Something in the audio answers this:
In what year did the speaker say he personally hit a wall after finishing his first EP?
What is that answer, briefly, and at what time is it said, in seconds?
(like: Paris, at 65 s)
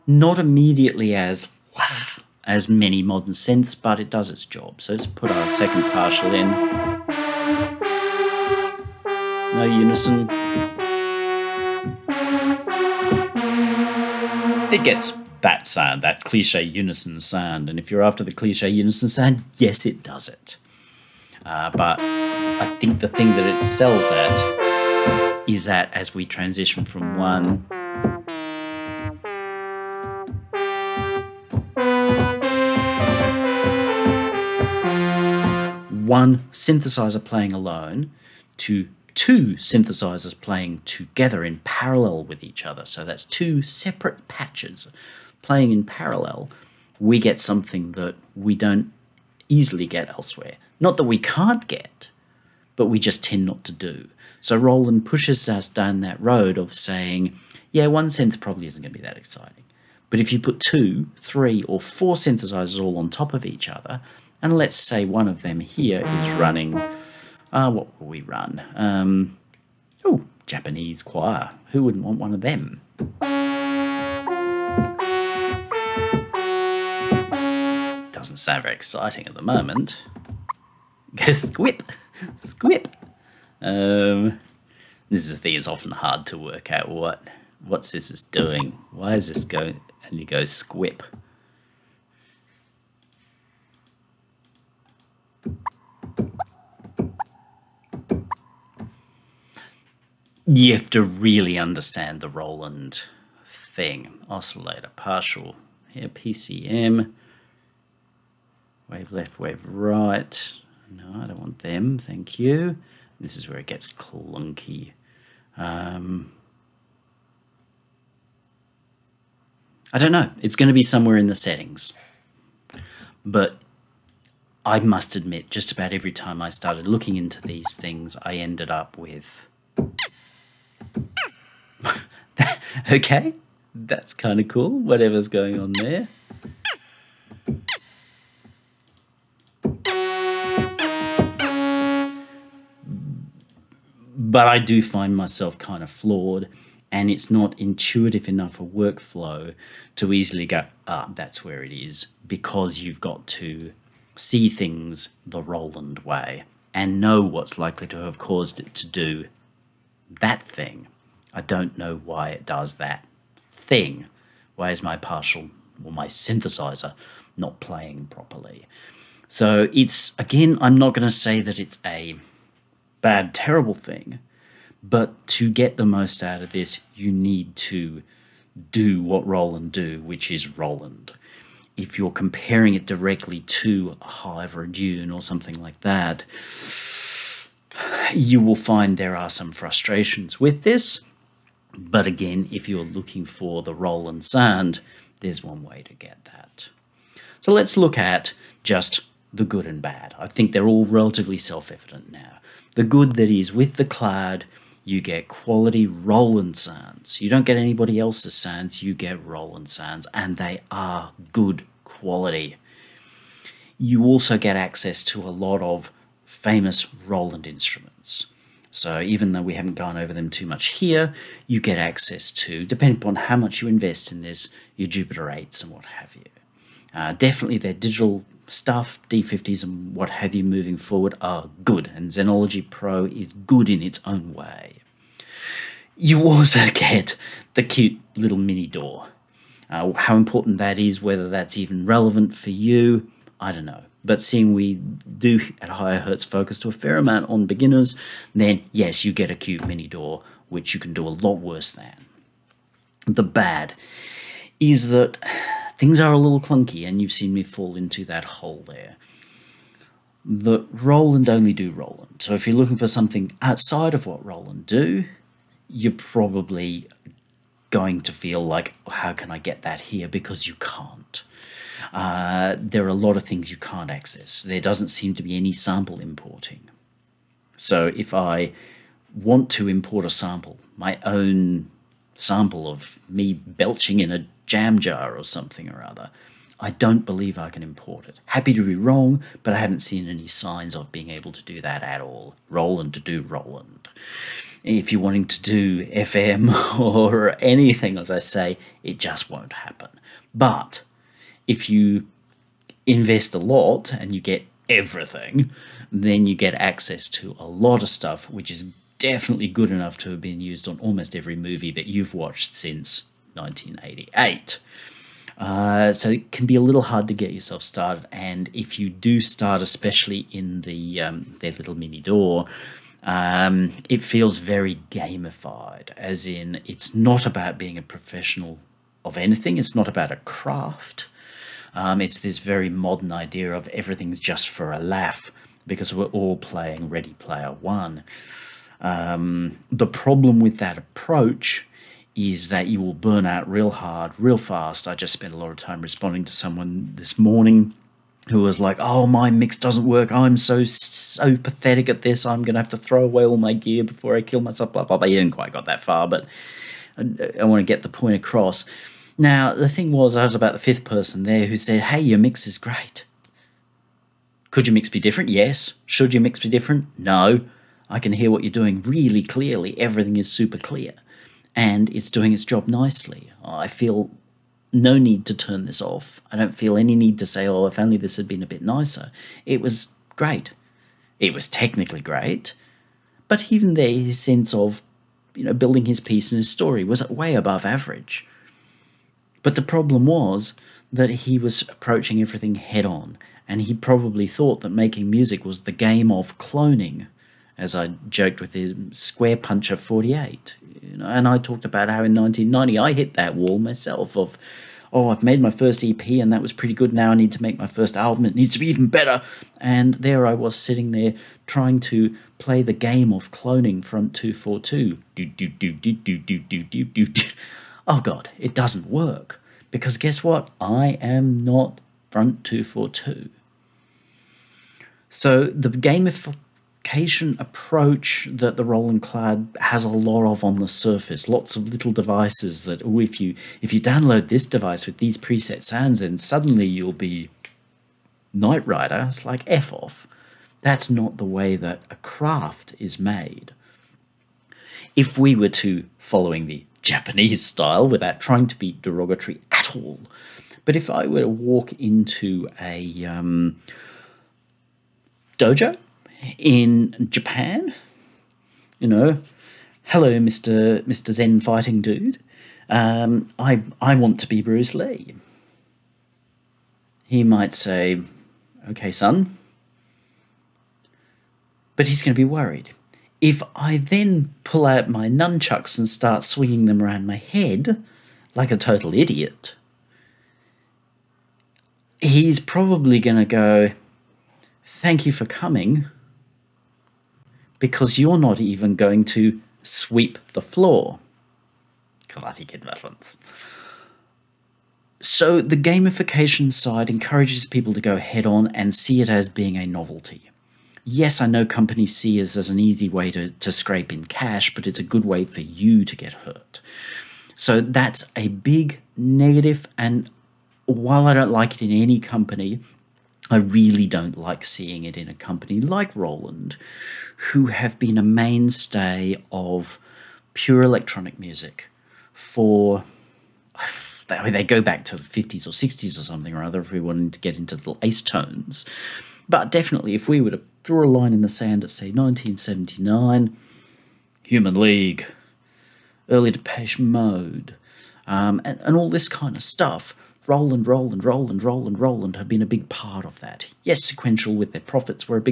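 1990, at 402 s.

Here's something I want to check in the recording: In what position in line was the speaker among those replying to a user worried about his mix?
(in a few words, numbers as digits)
5th.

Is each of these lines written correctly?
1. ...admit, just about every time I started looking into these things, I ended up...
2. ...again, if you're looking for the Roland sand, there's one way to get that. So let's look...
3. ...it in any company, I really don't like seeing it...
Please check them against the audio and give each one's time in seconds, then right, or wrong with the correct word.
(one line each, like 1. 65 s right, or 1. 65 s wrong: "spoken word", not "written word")
1. 125 s right
2. 192 s right
3. 511 s right.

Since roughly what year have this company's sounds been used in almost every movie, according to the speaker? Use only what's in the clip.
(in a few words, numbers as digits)
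1988.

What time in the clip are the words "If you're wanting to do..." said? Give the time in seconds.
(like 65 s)
294 s.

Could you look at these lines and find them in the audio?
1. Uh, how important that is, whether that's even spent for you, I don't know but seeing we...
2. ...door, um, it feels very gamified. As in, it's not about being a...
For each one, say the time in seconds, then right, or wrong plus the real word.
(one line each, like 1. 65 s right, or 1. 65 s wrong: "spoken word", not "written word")
1. 239 s wrong: "relevant", not "spent"
2. 321 s right.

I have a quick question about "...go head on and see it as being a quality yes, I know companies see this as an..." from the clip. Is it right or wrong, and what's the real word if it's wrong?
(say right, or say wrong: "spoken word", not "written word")
wrong: "novelty", not "quality".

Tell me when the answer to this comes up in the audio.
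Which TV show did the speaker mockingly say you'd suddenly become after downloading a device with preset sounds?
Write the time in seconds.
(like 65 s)
438 s.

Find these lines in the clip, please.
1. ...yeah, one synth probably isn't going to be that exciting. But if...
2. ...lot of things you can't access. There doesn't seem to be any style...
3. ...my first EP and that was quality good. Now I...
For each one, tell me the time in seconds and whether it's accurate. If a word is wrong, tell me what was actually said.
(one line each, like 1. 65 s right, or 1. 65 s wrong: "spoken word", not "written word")
1. 57 s right
2. 272 s wrong: "sample", not "style"
3. 405 s wrong: "pretty", not "quality".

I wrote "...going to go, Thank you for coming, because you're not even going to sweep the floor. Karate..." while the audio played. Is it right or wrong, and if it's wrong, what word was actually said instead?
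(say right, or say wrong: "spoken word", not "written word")
right.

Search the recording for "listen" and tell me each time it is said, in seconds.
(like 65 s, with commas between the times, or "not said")
not said.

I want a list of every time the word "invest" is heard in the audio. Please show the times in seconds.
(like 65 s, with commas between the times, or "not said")
223 s, 302 s.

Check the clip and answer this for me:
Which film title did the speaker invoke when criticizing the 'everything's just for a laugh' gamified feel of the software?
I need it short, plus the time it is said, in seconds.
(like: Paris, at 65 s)
Ready Player One, at 336 s.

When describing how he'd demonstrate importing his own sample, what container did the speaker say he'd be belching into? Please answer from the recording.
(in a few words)
jam jar.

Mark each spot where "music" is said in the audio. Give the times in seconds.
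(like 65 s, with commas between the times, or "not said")
395 s, 521 s.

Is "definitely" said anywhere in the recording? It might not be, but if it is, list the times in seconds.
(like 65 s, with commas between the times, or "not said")
227 s, 308 s, 529 s.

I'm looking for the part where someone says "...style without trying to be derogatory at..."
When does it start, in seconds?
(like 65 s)
447 s.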